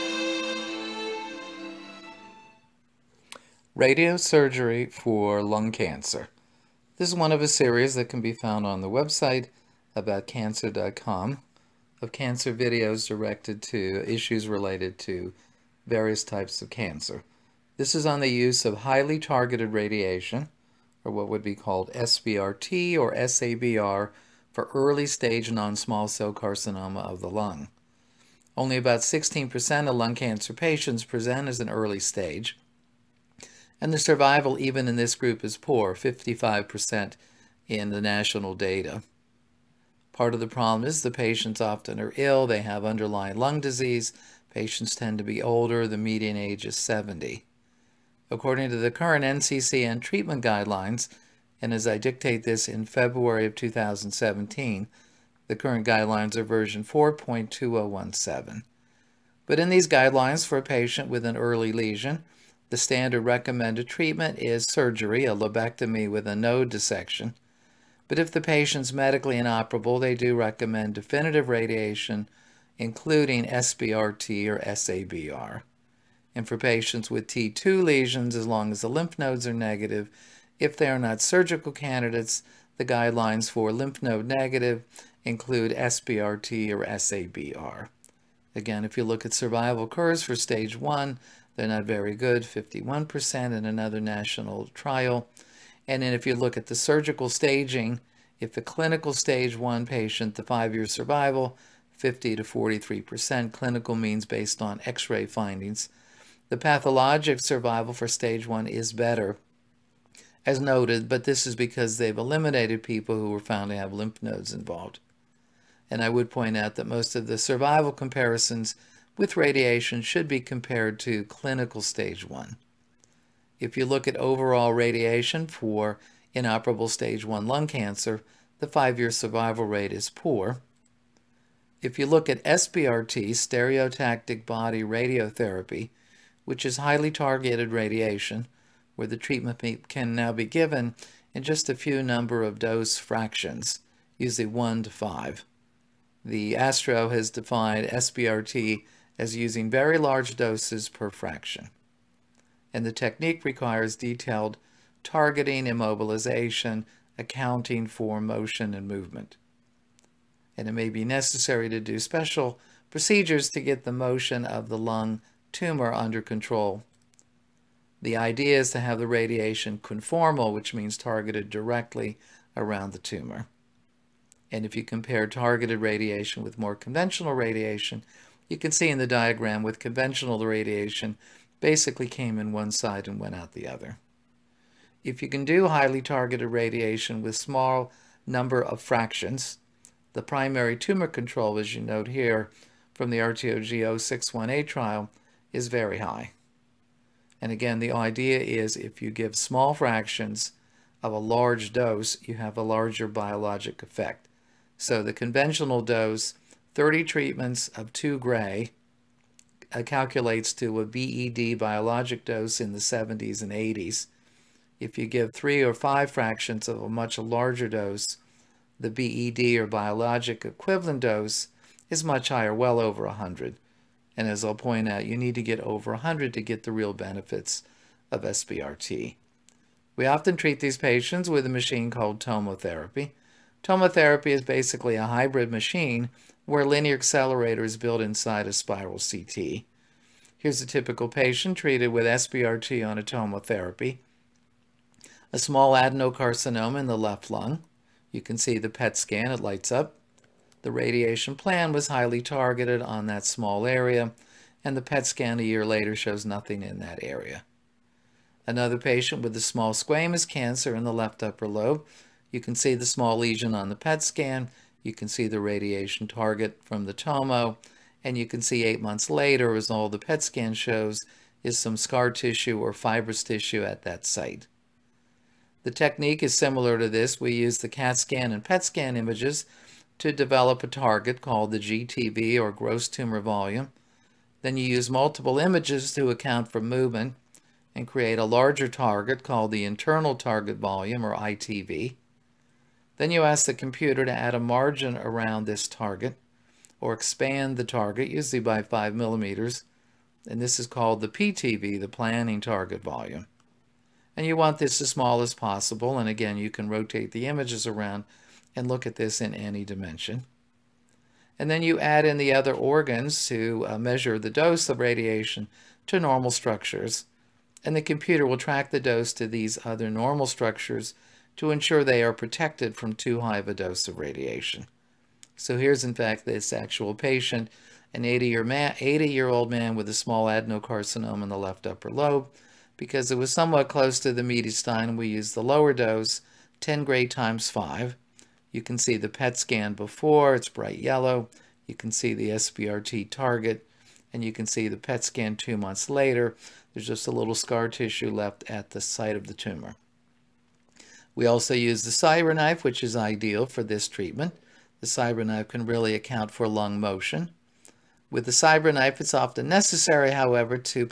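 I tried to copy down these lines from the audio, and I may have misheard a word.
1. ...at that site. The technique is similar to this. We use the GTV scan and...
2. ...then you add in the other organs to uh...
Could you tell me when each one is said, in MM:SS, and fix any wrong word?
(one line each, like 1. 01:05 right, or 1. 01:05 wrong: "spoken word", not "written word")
1. 04:33 wrong: "CAT", not "GTV"
2. 05:11 right.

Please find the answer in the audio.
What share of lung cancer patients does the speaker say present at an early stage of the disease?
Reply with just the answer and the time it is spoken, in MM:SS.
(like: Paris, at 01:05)
16%, at 00:29.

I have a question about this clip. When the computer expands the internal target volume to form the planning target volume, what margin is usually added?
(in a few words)
5 millimeters.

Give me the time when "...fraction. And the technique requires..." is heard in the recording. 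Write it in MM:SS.
02:31.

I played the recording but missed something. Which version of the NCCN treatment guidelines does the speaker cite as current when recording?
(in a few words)
4.2017.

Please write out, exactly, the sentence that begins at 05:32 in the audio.
Because it was somewhat close to the mediastinum, we used the lower dose, 10 gray times 5.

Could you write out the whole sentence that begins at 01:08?
But if the patient's medically inoperable, they do recommend definitive radiation, including SBRT or SABR.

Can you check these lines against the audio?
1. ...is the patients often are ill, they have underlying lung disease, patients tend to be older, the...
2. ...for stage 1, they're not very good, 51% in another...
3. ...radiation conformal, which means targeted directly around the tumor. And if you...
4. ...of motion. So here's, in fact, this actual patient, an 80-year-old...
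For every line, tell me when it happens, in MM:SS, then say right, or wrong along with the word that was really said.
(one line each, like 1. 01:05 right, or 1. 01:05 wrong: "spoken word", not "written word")
1. 00:40 right
2. 01:30 right
3. 02:49 right
4. 05:23 wrong: "radiation", not "motion".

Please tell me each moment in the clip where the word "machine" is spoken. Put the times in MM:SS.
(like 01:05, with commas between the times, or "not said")
03:51, 03:55.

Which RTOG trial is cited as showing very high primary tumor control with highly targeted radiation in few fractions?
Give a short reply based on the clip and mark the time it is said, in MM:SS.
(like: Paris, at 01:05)
RTOG 0618, at 03:13.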